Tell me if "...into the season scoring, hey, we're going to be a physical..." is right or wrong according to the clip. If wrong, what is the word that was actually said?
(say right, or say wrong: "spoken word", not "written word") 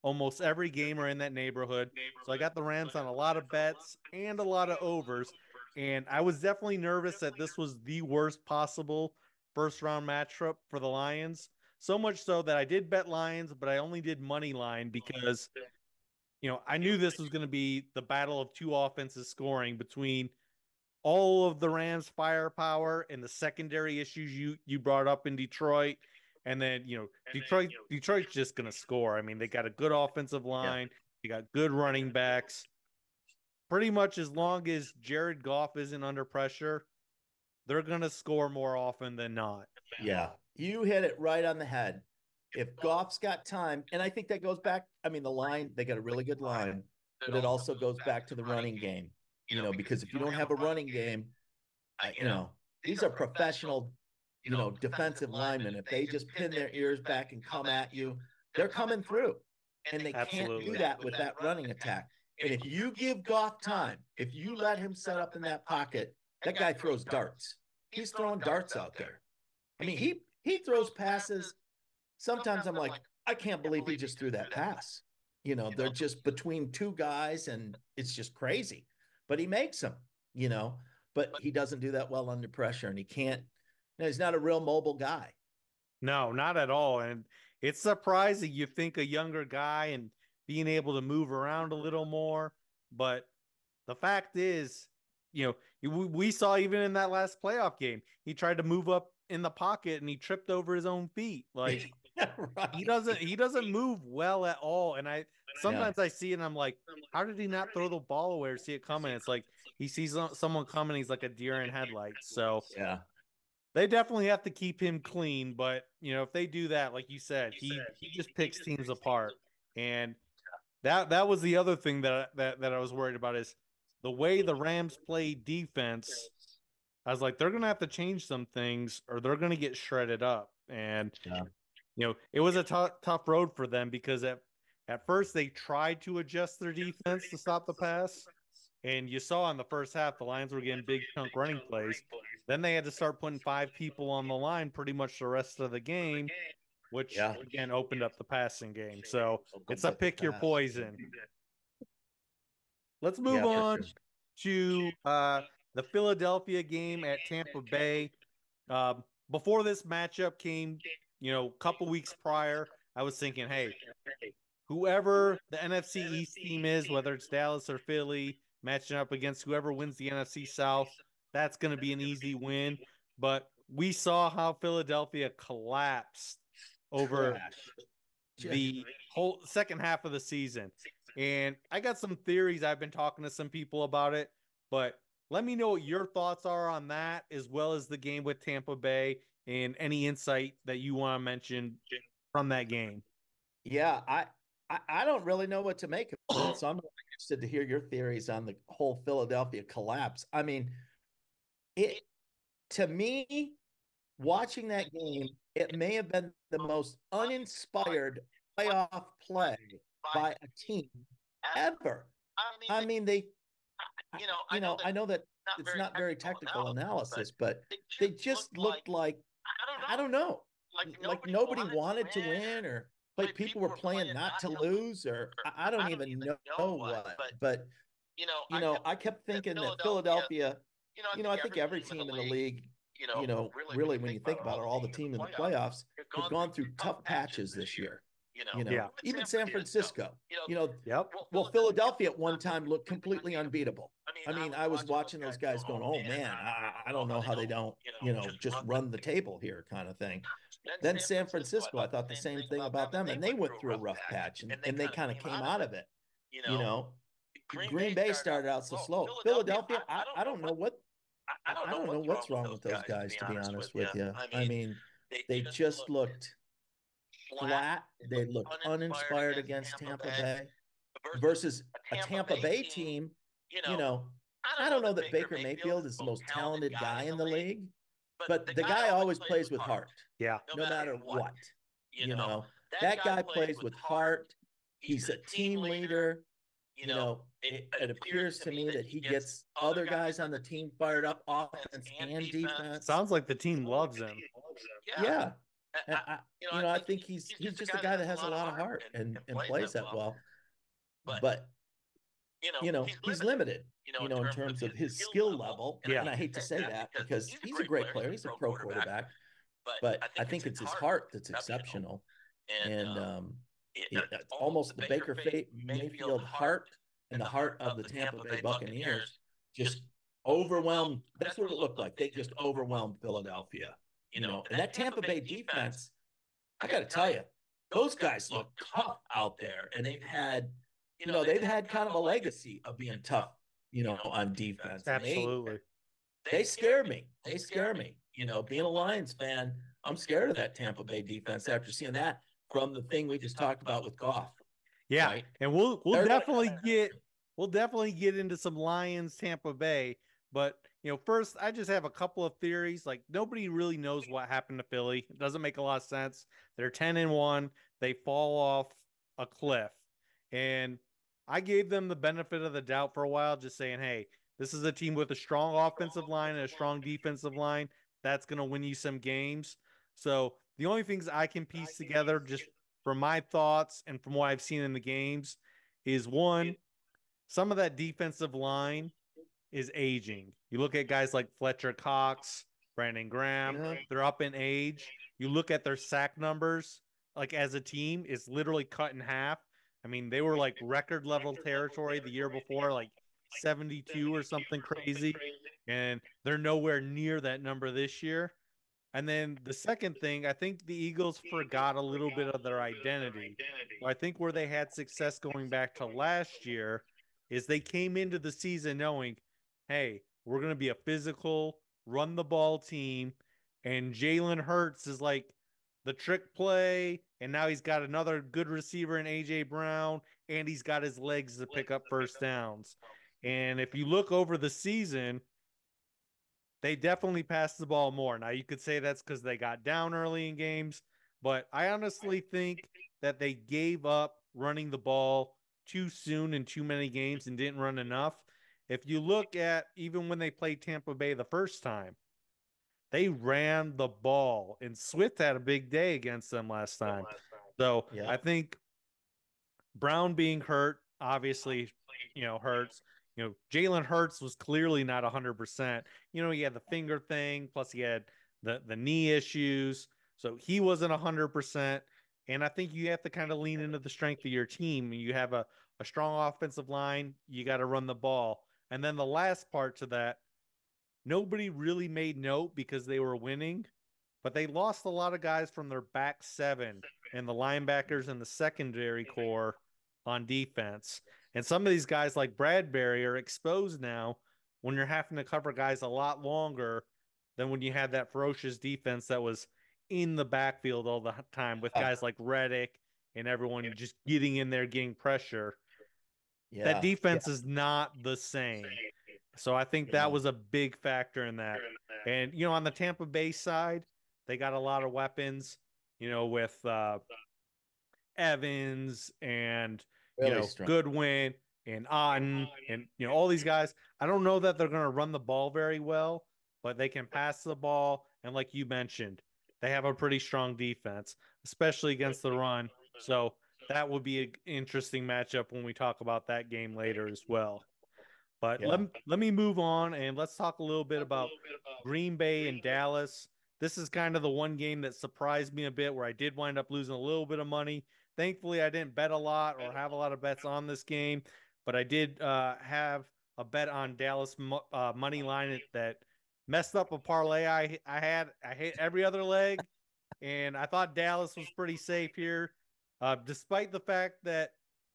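wrong: "knowing", not "scoring".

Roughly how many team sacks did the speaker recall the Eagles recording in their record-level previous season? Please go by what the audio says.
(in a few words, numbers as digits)
72.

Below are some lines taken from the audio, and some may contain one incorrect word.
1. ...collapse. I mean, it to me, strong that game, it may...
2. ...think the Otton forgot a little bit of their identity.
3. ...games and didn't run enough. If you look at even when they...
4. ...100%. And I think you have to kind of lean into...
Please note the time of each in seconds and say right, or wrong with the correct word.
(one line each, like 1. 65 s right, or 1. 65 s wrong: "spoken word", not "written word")
1. 199 s wrong: "watching", not "strong"
2. 400 s wrong: "Eagles", not "Otton"
3. 436 s right
4. 460 s right.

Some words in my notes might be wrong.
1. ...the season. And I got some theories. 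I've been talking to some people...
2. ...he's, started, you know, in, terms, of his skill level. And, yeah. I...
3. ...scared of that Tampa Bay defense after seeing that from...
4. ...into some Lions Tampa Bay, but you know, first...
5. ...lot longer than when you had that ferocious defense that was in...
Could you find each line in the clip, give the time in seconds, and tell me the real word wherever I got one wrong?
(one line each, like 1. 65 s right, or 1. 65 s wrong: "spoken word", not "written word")
1. 180 s right
2. 303 s wrong: "limited", not "started"
3. 339 s right
4. 348 s right
5. 485 s right.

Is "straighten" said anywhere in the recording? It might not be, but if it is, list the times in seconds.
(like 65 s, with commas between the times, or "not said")
not said.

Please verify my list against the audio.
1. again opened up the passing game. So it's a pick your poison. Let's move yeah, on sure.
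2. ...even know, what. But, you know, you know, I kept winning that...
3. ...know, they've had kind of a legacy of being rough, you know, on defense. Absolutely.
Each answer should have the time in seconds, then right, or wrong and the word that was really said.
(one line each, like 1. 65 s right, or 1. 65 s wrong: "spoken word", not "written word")
1. 147 s right
2. 225 s wrong: "thinking", not "winning"
3. 331 s wrong: "tough", not "rough".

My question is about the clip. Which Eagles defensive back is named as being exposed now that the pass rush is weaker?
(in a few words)
Bradberry.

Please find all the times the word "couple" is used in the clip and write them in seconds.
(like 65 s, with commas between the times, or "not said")
161 s, 351 s.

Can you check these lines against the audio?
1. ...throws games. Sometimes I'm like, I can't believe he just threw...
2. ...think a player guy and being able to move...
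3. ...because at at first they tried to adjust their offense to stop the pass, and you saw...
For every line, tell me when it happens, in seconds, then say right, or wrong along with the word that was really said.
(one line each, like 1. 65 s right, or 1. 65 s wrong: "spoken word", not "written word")
1. 70 s wrong: "passes", not "games"
2. 88 s wrong: "younger", not "player"
3. 133 s wrong: "defense", not "offense".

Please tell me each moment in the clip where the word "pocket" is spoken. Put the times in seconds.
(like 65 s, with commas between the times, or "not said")
65 s, 99 s.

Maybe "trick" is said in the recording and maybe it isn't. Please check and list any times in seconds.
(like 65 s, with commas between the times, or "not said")
415 s.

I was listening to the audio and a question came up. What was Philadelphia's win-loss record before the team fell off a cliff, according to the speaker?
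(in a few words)
10 and 1.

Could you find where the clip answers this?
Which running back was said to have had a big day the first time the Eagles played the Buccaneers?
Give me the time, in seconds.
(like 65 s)
444 s.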